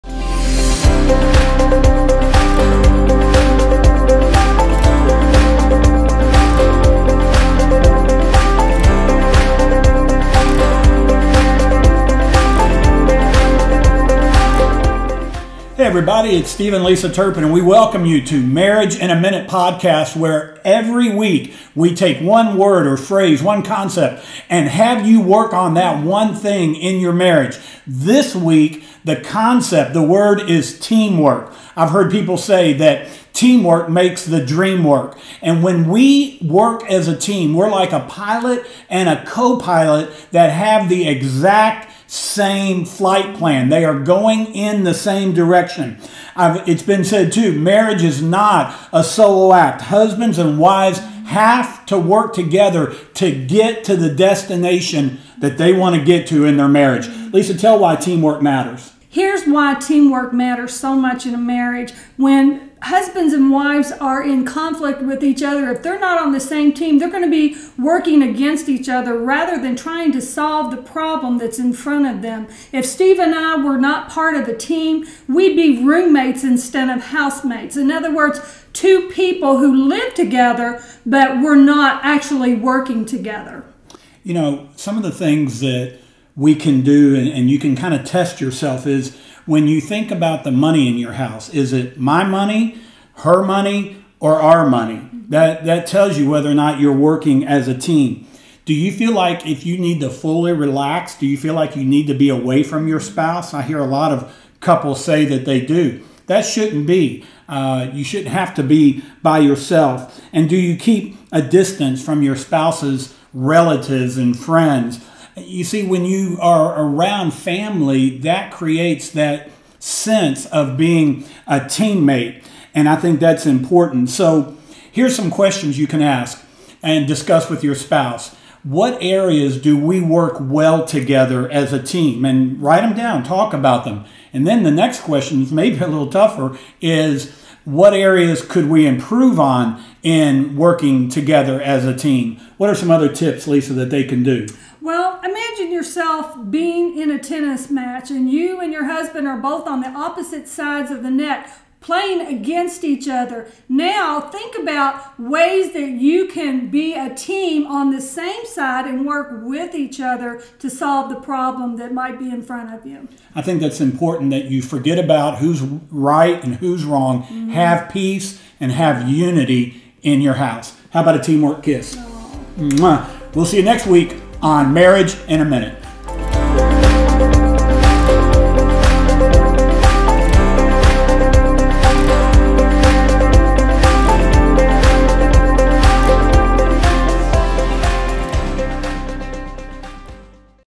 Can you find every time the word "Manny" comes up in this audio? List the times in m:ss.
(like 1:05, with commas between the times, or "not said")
not said.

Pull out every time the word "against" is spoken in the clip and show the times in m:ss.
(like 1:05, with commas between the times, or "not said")
1:08, 2:32.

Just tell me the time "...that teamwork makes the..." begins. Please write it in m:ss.
0:32.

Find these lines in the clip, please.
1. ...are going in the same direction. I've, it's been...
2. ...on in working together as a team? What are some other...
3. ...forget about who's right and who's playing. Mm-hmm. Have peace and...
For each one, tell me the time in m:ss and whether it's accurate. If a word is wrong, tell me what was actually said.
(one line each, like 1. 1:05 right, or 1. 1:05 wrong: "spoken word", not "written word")
1. 0:43 right
2. 2:19 right
3. 2:44 wrong: "wrong", not "playing".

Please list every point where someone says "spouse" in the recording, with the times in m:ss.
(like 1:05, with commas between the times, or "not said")
1:42, 1:52, 2:07.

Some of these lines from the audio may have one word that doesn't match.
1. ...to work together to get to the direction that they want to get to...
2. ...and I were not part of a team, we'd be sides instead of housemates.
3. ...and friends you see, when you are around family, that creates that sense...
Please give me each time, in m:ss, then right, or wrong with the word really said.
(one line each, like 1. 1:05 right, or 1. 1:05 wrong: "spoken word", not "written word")
1. 0:51 wrong: "destination", not "direction"
2. 1:13 wrong: "roommates", not "sides"
3. 1:54 right.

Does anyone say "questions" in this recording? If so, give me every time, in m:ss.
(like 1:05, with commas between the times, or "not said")
2:05, 2:15.